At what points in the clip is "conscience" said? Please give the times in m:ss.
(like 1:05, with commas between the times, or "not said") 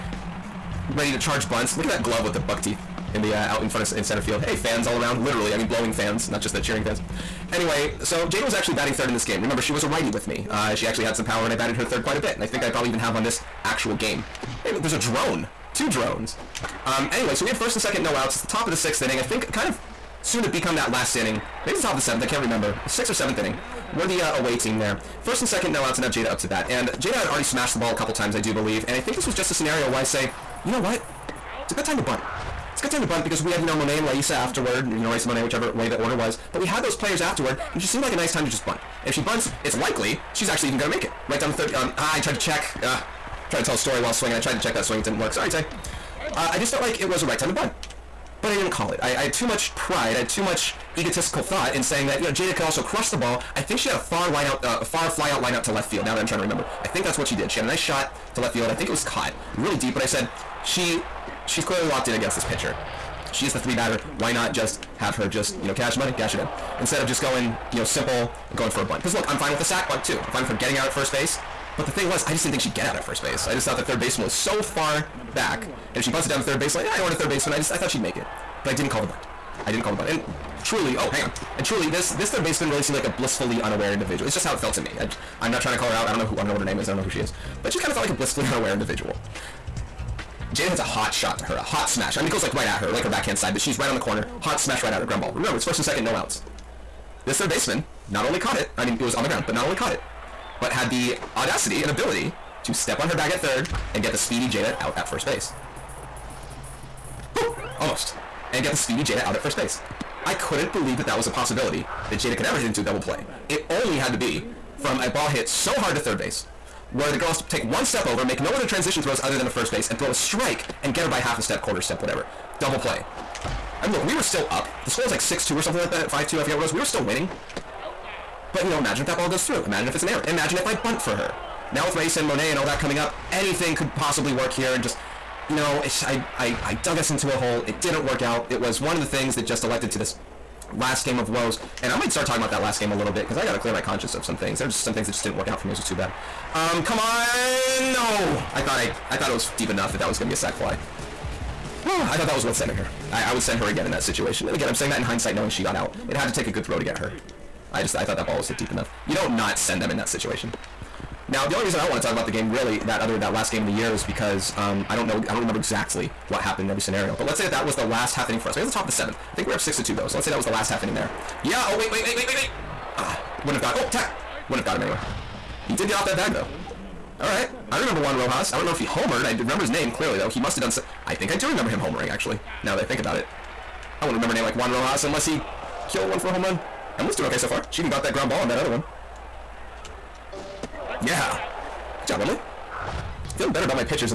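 2:23.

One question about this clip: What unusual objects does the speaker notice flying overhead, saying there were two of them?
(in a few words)
Drones.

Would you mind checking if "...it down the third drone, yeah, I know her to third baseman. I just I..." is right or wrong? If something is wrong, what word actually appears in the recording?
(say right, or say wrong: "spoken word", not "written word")
wrong: "baseline", not "drone".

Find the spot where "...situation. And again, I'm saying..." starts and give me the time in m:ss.
2:34.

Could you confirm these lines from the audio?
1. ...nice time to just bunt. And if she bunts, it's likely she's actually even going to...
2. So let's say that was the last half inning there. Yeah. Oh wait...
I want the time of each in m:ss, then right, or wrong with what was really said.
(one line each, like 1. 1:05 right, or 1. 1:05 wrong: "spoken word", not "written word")
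1. 0:38 right
2. 2:50 right.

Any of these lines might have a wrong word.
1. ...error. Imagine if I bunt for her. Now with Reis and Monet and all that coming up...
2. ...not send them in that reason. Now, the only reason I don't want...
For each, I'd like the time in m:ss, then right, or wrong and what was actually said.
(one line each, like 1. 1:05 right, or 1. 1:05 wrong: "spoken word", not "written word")
1. 2:10 right
2. 2:39 wrong: "situation", not "reason".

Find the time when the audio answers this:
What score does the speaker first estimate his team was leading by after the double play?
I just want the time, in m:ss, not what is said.
2:05.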